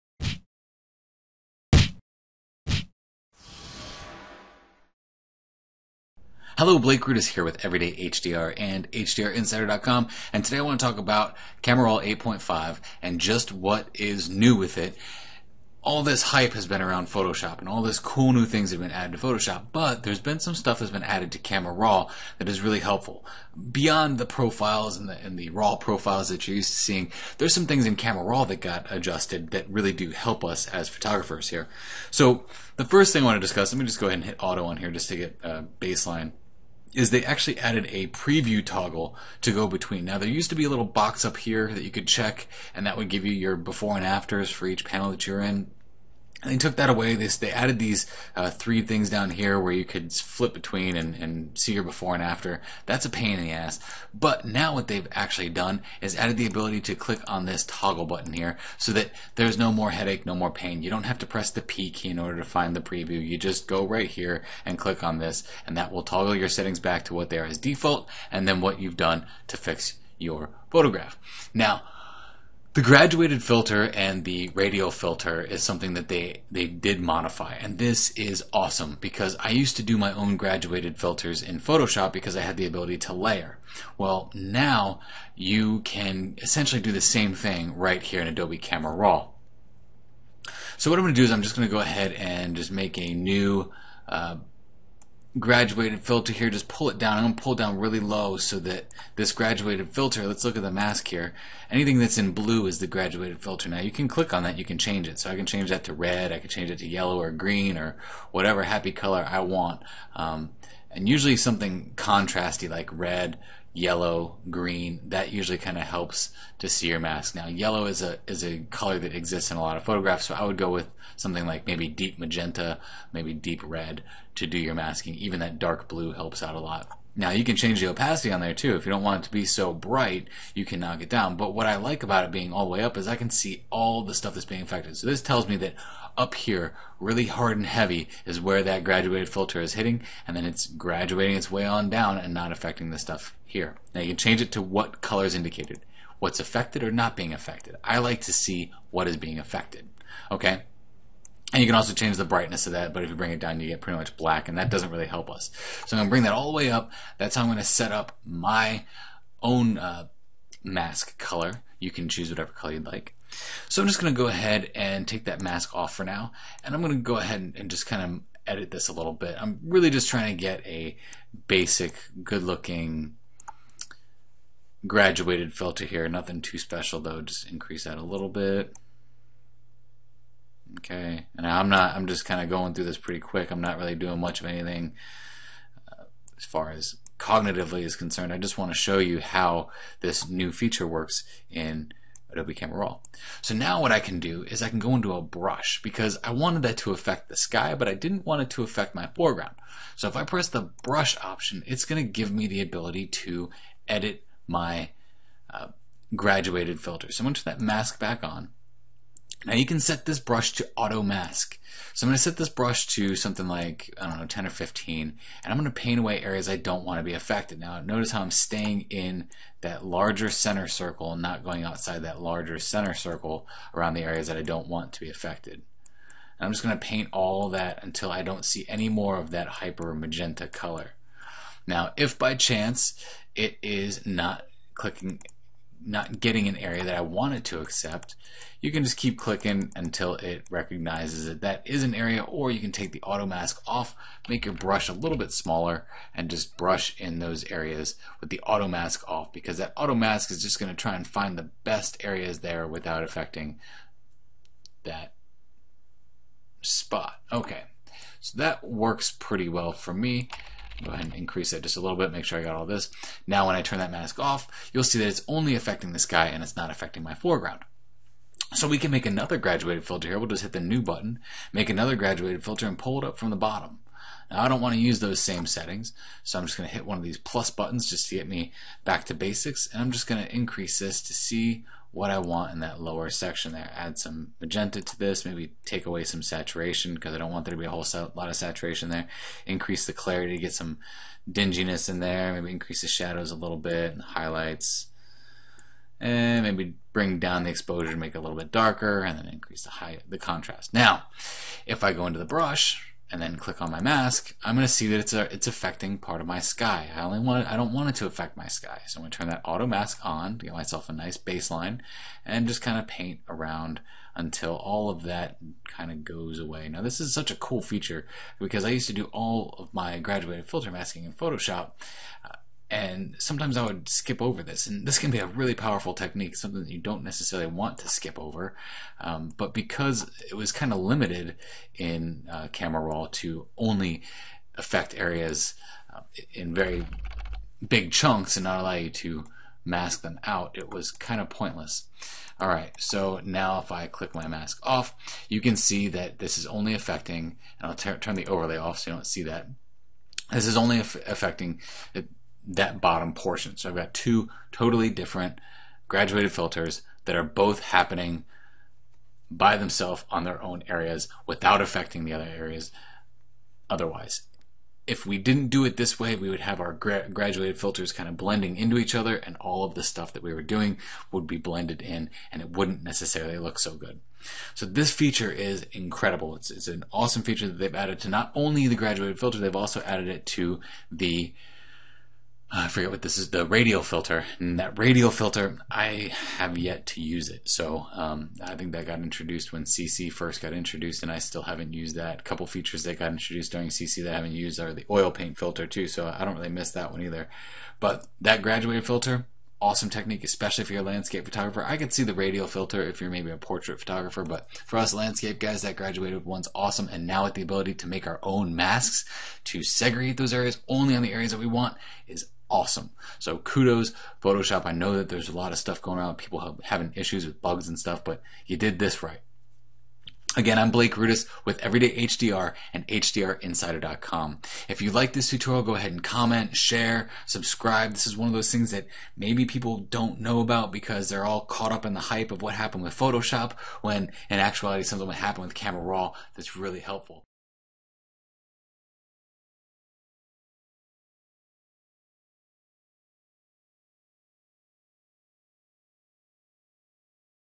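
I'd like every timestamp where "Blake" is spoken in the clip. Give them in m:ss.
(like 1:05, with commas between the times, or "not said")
0:06, 7:00.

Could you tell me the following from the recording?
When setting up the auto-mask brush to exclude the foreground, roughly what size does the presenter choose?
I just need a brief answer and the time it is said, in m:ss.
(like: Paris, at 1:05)
10 or 15, at 3:34.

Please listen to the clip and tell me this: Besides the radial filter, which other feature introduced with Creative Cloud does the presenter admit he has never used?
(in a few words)
Oil paint filter.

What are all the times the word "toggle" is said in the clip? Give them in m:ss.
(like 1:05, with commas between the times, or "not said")
0:38, 0:57, 1:06.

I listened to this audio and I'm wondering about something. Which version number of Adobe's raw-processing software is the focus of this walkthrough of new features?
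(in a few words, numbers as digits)
8.5.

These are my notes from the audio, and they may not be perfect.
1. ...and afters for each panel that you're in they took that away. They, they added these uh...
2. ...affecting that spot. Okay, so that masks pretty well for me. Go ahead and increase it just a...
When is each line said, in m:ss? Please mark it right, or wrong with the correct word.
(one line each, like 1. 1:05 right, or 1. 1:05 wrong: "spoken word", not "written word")
1. 0:43 right
2. 4:13 wrong: "works", not "masks".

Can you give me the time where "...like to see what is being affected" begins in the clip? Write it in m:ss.
2:27.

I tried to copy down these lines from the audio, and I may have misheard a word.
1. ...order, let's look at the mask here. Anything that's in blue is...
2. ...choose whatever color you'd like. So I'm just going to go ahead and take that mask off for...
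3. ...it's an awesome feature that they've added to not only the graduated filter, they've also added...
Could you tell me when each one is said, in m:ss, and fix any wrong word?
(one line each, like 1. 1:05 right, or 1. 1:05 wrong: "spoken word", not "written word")
1. 1:39 wrong: "filter", not "order"
2. 2:42 right
3. 6:16 right.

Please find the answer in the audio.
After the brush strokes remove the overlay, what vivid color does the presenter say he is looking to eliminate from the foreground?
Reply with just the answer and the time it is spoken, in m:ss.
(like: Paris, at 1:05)
Hyper magenta, at 3:49.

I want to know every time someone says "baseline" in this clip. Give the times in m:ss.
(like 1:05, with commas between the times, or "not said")
0:35, 5:11.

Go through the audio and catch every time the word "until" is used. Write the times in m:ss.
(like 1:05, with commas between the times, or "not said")
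3:47, 3:59, 5:14.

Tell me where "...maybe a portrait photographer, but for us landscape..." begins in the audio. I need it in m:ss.
6:43.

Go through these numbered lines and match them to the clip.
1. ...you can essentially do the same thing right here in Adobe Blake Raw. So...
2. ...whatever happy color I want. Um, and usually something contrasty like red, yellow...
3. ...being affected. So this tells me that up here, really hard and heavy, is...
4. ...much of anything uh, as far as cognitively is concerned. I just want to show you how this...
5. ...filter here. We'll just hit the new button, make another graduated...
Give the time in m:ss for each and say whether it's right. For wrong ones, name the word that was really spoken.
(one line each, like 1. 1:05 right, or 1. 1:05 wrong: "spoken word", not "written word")
1. 1:25 wrong: "Camera", not "Blake"
2. 1:48 right
3. 2:14 right
4. 3:04 right
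5. 4:29 right.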